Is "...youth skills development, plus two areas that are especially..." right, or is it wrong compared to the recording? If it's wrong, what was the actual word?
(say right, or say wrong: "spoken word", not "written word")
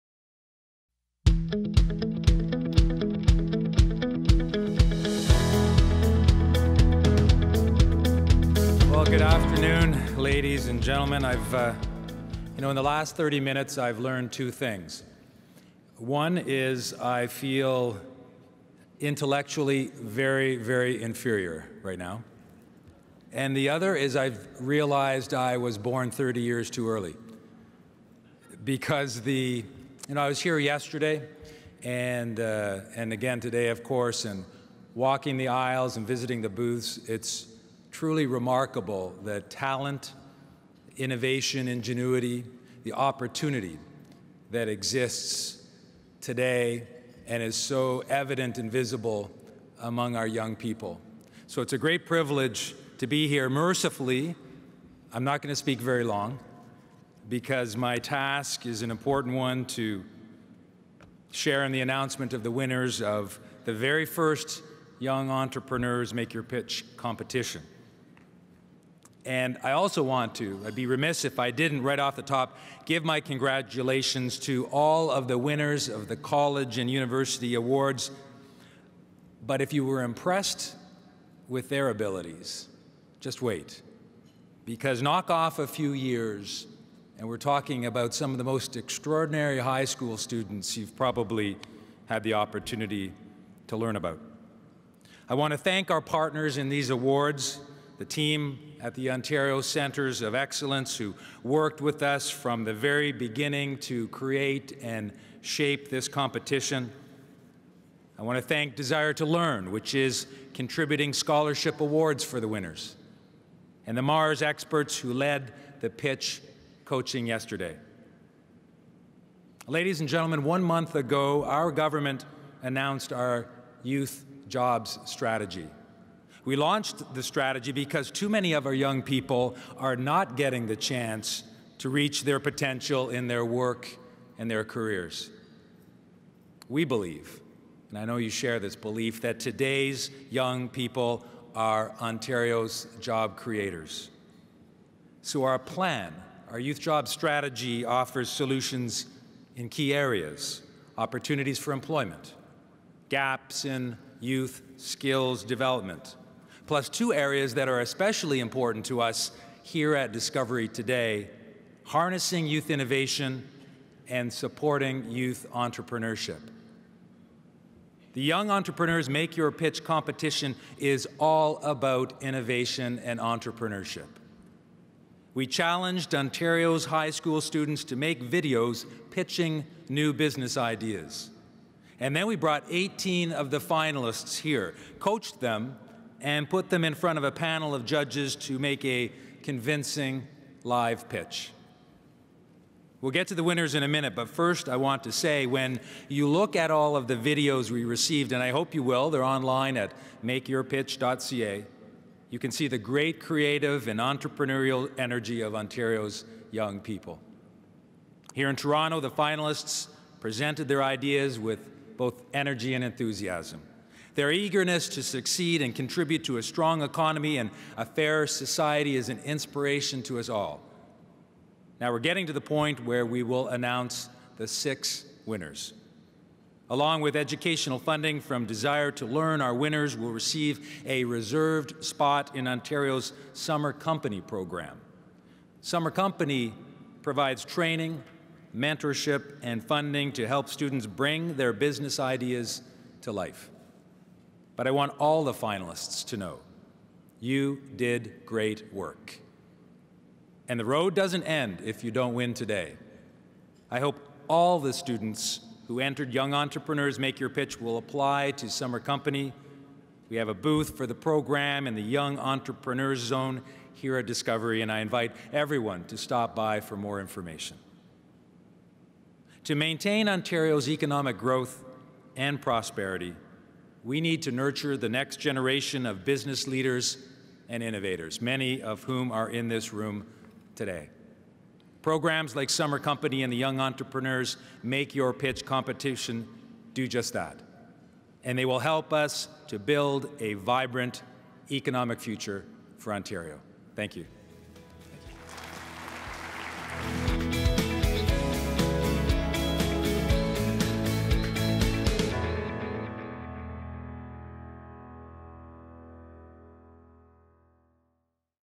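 right.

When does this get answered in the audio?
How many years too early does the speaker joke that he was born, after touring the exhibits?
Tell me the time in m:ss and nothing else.
0:26.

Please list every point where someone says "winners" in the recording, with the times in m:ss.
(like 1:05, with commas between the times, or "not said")
1:02, 1:15, 1:52, 3:13, 3:45, 3:49.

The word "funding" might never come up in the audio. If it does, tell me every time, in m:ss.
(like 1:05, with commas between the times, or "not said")
3:47, 3:59.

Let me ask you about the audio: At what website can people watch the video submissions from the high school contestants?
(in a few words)
makeyourpitch.ca.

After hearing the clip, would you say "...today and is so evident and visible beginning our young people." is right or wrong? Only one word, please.
wrong.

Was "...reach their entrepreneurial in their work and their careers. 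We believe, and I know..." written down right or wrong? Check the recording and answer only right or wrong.
wrong.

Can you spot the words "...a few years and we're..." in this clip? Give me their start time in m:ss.
1:25.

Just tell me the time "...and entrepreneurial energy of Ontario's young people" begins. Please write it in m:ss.
3:23.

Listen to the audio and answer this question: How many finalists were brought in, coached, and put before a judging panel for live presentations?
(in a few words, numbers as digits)
18.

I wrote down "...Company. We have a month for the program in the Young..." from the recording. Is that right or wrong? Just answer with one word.
wrong.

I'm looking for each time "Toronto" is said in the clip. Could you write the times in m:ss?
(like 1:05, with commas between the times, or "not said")
3:28.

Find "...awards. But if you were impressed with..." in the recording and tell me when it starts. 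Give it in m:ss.
1:17.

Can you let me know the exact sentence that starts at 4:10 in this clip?
And the road doesn't end if you don't win today.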